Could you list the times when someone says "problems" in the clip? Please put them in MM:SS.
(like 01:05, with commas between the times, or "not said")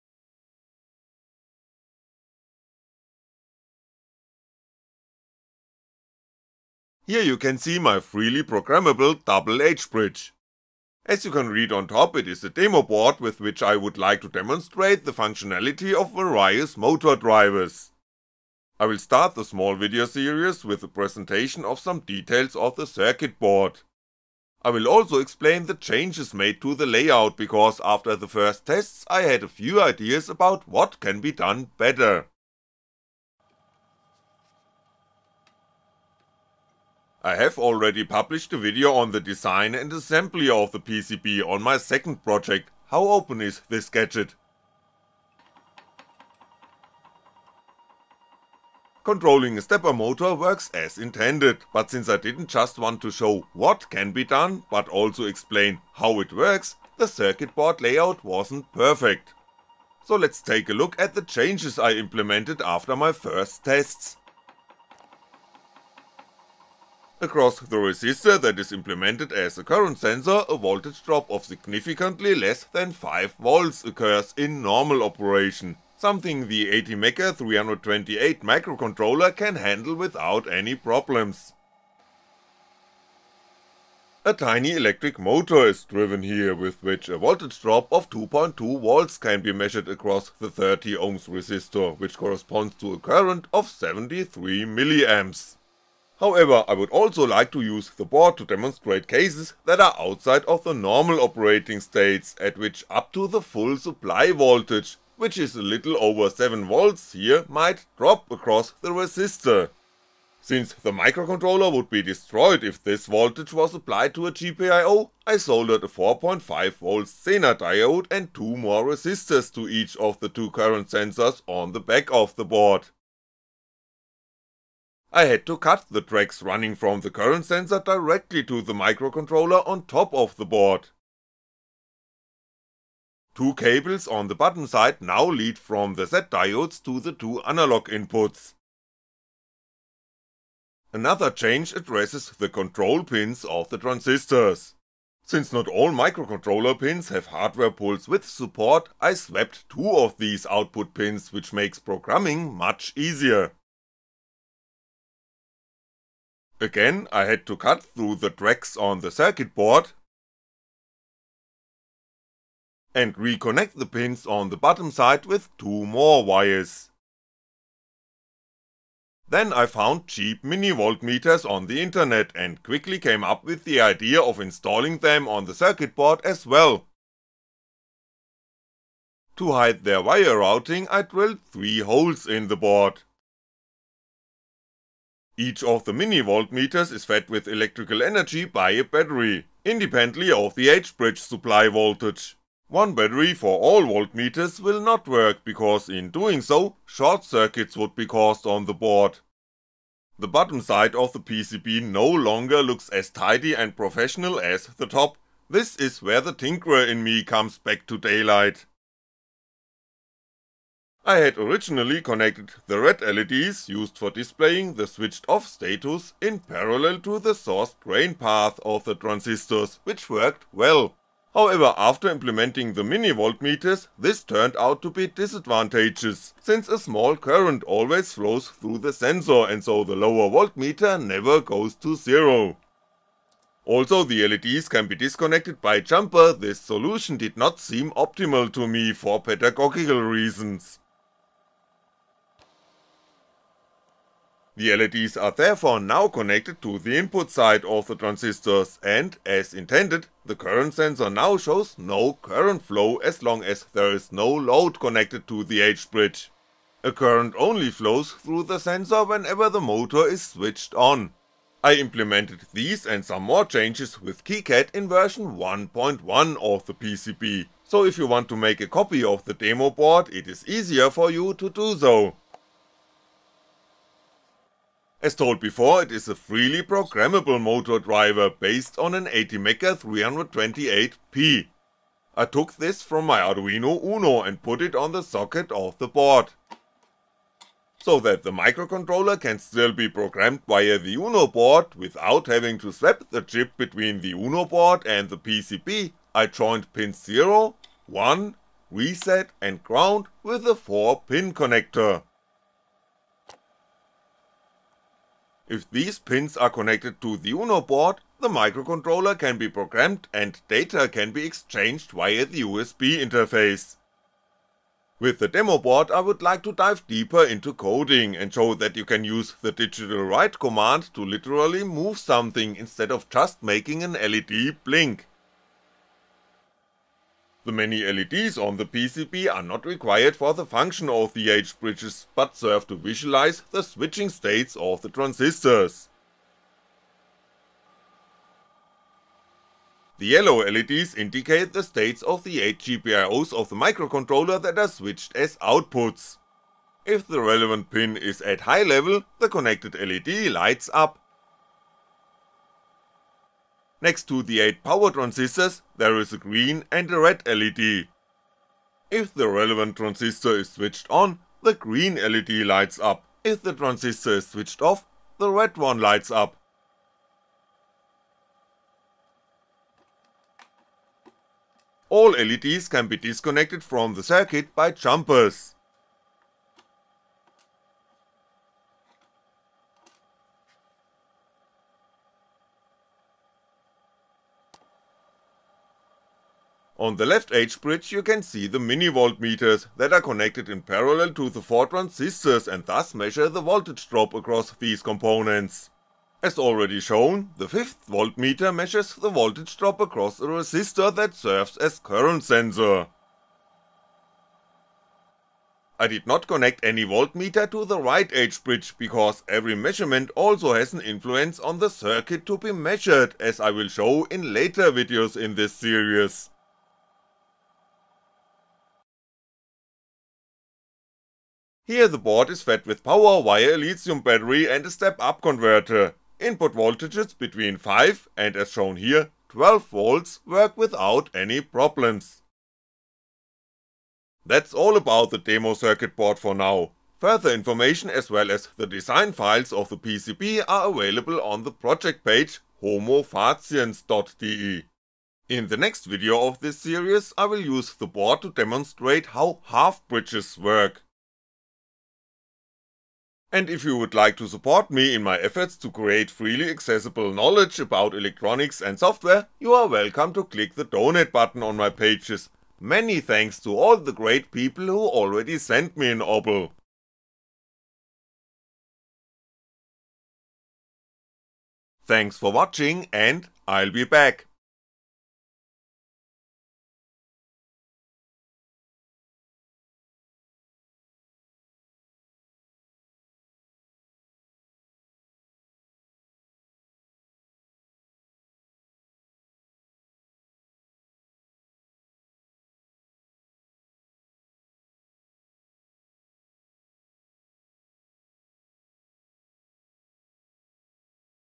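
01:20, 07:11.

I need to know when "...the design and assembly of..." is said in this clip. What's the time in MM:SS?
00:39.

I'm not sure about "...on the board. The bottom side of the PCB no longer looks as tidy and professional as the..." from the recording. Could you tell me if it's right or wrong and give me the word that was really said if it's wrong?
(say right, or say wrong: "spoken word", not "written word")
right.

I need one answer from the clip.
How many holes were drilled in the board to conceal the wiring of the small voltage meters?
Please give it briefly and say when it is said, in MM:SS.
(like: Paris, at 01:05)
3, at 03:01.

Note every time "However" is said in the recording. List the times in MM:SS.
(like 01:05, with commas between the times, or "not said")
01:36, 03:41.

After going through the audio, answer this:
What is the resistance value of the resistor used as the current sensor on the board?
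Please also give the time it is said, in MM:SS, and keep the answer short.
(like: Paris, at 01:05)
30 ohms, at 01:30.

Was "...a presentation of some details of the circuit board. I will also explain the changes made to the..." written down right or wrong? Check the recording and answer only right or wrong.
right.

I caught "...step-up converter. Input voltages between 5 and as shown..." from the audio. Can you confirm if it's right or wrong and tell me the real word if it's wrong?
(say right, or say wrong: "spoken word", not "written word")
right.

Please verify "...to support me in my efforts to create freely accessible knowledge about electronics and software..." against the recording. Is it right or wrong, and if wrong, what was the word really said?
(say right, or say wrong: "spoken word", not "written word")
right.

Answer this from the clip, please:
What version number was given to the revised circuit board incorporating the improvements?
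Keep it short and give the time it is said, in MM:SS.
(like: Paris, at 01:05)
1.1, at 04:25.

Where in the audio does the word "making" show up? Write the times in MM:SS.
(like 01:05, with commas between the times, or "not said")
05:23.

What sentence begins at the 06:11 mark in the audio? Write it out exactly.
All LEDs can be disconnected from the circuit by jumpers.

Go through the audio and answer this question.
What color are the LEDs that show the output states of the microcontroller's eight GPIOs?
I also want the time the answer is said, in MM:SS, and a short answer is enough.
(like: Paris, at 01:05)
Yellow, at 05:40.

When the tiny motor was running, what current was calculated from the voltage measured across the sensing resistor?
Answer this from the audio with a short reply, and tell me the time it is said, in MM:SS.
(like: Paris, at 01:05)
73mA, at 01:33.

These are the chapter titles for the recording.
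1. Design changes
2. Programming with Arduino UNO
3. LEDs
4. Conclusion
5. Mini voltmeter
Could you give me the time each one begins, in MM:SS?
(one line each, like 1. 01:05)
1. 00:48
2. 04:26
3. 03:25
4. 05:18
5. 02:43.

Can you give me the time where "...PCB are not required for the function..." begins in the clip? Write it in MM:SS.
05:28.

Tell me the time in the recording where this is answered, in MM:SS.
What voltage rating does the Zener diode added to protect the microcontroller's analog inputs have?
01:55.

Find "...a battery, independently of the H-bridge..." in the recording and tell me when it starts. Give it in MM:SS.
03:08.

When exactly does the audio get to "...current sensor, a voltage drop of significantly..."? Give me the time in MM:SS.
01:09.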